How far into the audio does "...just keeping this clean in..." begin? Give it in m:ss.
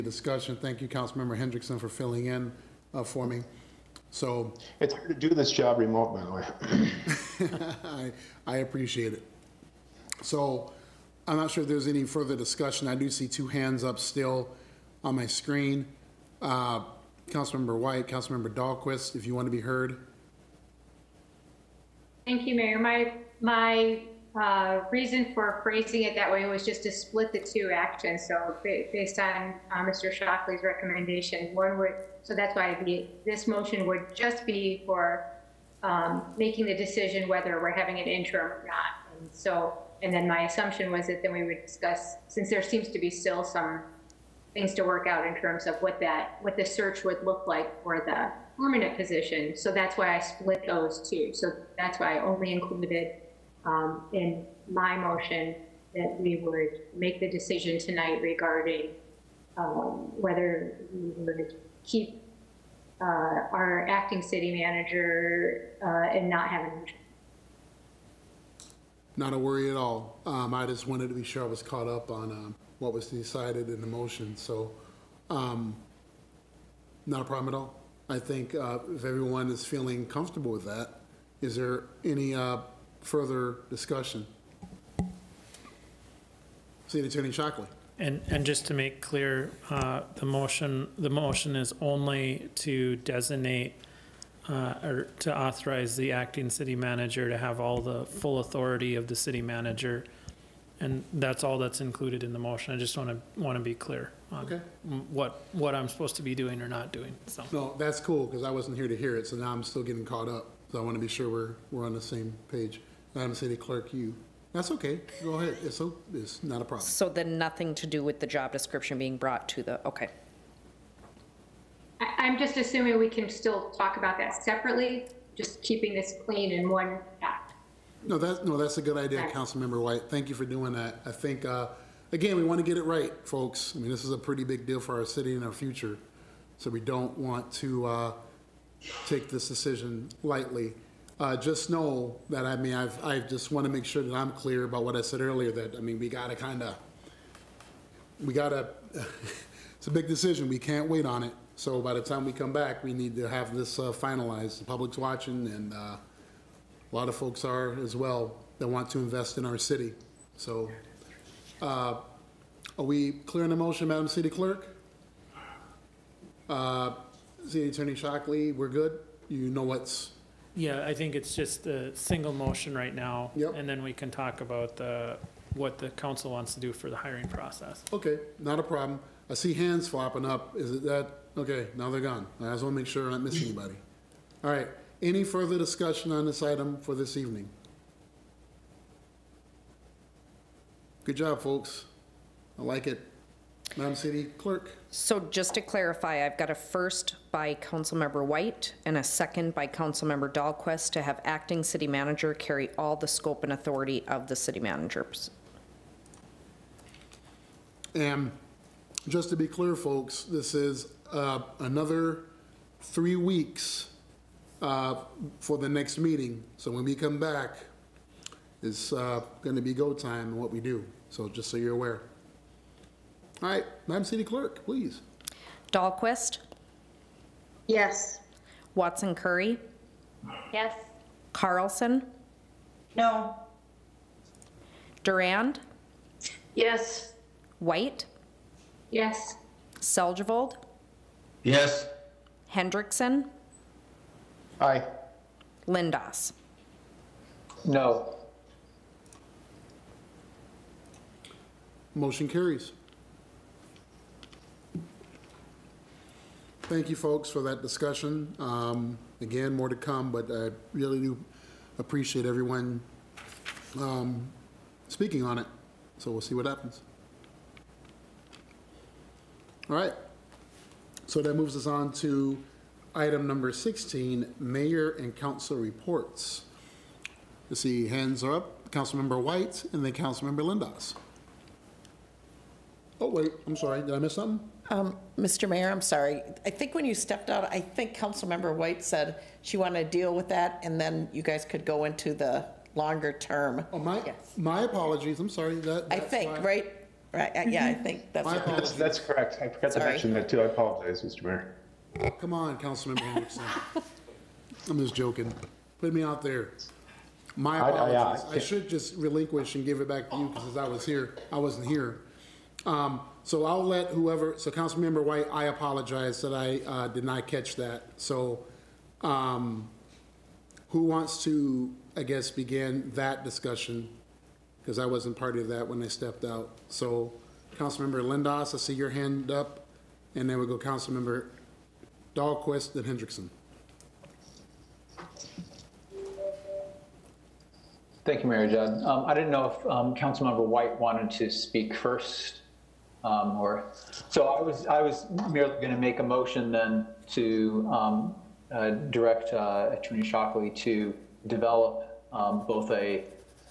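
2:05.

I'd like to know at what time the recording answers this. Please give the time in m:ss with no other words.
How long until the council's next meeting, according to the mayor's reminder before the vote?
3:32.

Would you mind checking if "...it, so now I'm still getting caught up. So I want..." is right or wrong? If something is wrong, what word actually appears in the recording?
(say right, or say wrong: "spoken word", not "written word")
right.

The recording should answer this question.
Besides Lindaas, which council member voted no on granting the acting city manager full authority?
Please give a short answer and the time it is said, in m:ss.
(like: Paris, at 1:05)
Carlson, at 3:51.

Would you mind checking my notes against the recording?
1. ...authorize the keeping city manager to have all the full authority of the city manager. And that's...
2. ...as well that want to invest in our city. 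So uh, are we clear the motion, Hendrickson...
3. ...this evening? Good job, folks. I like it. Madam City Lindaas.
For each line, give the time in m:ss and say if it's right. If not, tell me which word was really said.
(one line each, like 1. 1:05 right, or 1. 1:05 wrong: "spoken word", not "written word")
1. 1:35 wrong: "acting", not "keeping"
2. 2:37 wrong: "Madam", not "Hendrickson"
3. 3:06 wrong: "Clerk", not "Lindaas".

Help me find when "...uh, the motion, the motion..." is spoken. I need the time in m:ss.
1:29.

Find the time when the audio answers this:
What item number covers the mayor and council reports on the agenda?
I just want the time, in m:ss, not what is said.
4:33.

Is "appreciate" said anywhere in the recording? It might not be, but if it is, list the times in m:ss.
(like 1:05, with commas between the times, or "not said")
0:08, 4:21.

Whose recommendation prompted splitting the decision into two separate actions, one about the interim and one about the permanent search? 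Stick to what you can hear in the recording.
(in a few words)
Mr. Shockley.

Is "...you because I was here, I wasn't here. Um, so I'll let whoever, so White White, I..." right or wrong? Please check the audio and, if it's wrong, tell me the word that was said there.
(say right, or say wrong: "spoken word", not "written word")
wrong: "Councilmember", not "White".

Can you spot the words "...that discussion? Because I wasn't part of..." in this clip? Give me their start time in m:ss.
5:22.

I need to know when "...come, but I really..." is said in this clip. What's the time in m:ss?
4:19.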